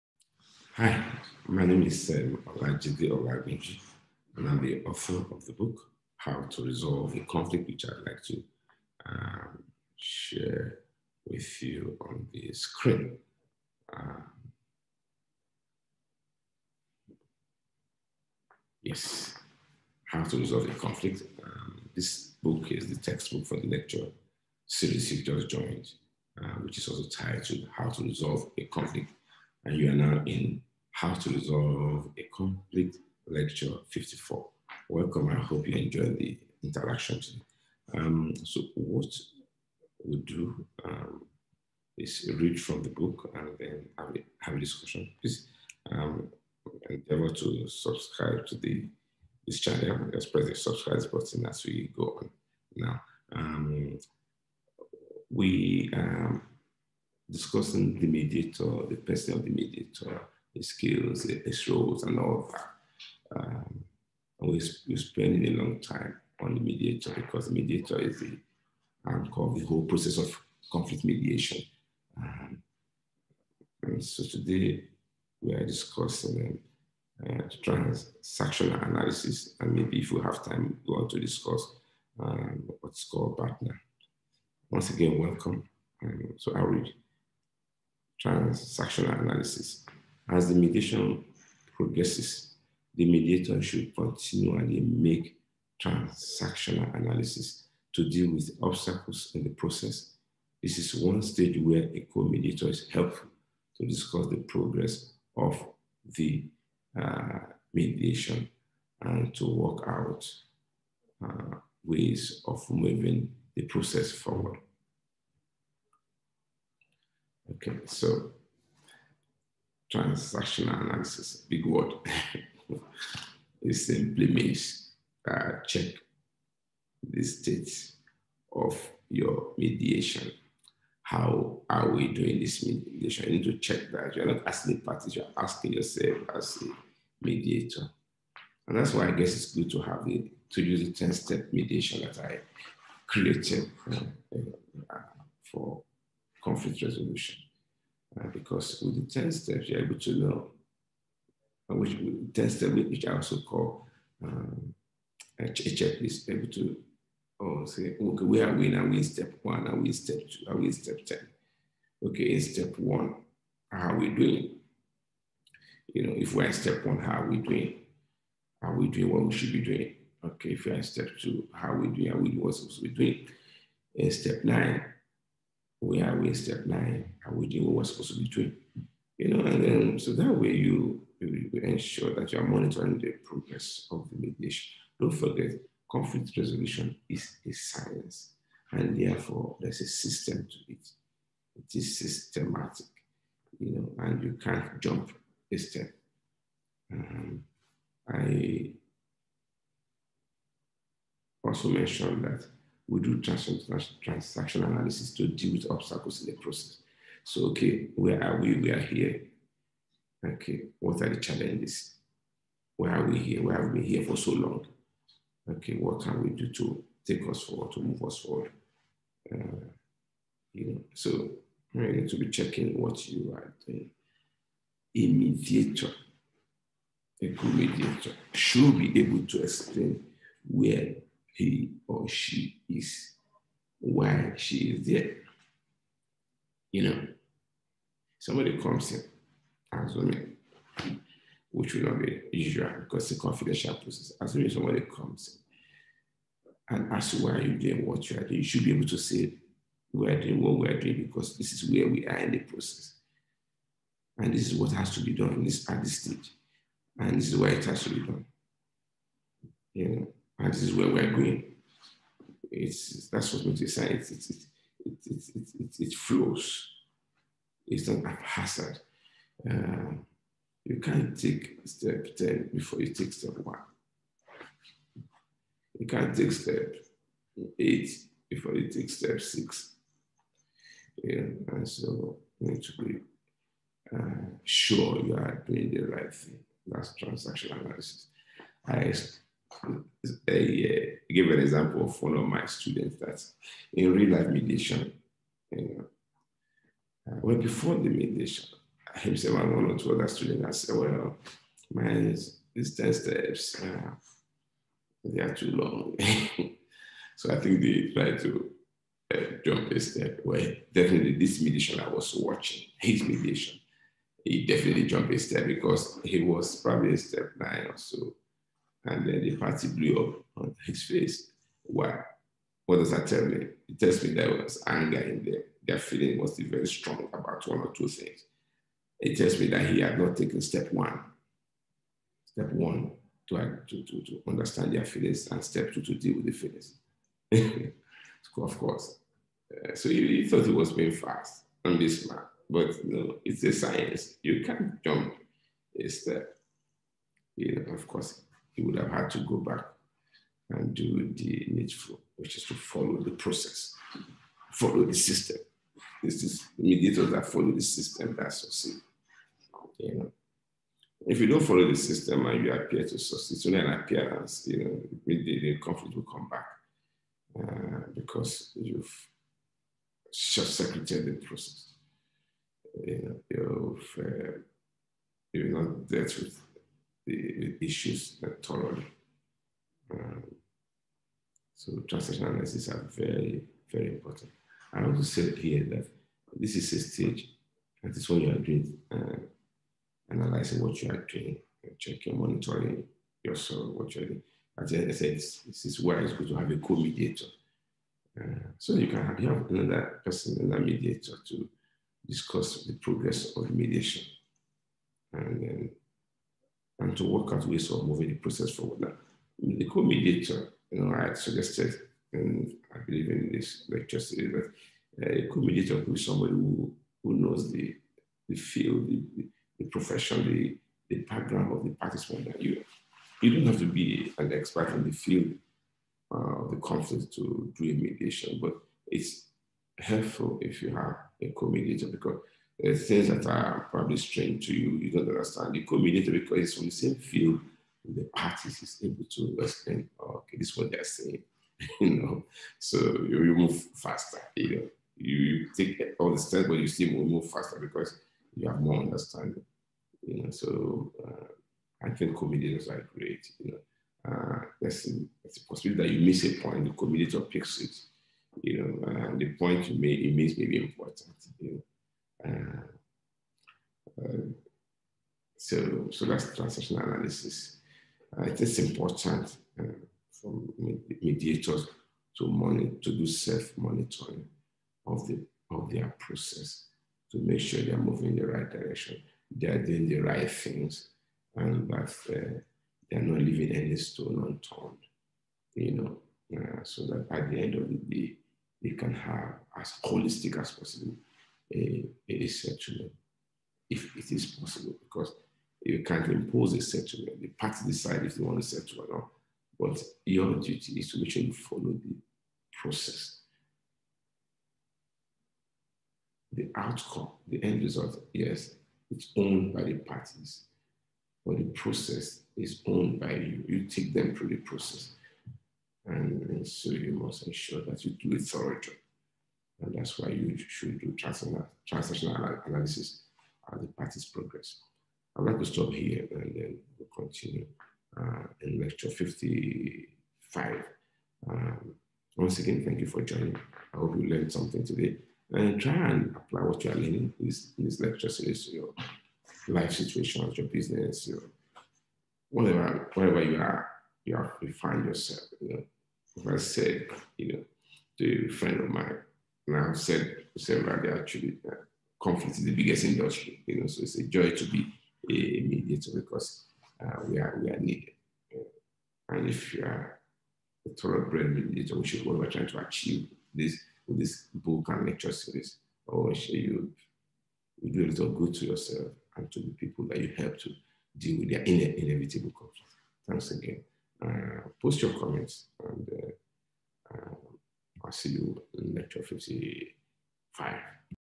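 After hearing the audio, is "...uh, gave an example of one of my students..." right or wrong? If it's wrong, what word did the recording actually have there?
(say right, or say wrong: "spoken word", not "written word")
right.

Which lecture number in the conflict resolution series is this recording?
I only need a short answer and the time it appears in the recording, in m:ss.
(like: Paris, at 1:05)
54, at 0:33.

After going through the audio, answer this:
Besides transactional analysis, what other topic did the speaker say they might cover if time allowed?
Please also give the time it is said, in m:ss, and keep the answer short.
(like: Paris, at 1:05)
Partner, at 1:23.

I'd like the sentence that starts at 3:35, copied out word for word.
Okay, what can we do to take us forward, to move us forward?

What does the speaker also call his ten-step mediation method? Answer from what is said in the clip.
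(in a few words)
A checklist.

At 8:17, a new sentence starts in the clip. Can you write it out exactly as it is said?
The parties decide if they want a settlement or not.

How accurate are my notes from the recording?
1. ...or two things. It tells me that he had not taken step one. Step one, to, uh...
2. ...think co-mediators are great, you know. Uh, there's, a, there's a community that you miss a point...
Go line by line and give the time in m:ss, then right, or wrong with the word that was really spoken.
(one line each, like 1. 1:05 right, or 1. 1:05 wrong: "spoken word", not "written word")
1. 5:27 right
2. 7:31 wrong: "possibility", not "community".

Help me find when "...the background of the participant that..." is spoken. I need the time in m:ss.
7:00.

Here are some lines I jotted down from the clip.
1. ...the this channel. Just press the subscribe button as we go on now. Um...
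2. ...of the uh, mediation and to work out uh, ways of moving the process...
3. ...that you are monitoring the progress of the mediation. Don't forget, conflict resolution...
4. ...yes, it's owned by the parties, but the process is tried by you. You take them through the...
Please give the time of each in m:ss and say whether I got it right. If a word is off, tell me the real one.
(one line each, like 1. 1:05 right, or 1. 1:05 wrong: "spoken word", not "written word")
1. 0:48 right
2. 1:45 right
3. 3:02 right
4. 8:28 wrong: "owned", not "tried".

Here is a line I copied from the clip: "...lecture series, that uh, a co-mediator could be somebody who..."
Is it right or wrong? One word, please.
right.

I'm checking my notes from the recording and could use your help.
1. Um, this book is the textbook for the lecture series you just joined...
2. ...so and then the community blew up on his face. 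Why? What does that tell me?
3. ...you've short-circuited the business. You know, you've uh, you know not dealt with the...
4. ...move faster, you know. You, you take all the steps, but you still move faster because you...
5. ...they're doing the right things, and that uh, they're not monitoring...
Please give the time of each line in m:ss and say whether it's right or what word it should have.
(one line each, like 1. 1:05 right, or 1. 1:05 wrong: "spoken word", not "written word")
1. 0:21 right
2. 5:17 wrong: "party", not "community"
3. 6:08 wrong: "process", not "business"
4. 7:23 right
5. 7:59 wrong: "leaving", not "monitoring".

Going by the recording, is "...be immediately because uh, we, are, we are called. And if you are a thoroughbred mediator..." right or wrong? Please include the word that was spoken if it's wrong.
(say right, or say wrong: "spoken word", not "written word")
wrong: "needed", not "called".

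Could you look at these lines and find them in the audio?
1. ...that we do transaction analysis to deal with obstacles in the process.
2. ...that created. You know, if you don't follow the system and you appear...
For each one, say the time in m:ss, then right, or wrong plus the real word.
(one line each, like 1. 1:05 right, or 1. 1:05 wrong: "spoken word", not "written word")
1. 3:22 right
2. 5:58 wrong: "succeed", not "created".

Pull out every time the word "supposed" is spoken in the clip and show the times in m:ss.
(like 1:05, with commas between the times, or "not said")
2:57.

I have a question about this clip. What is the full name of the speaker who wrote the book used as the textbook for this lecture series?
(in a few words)
Olajide Olabinji.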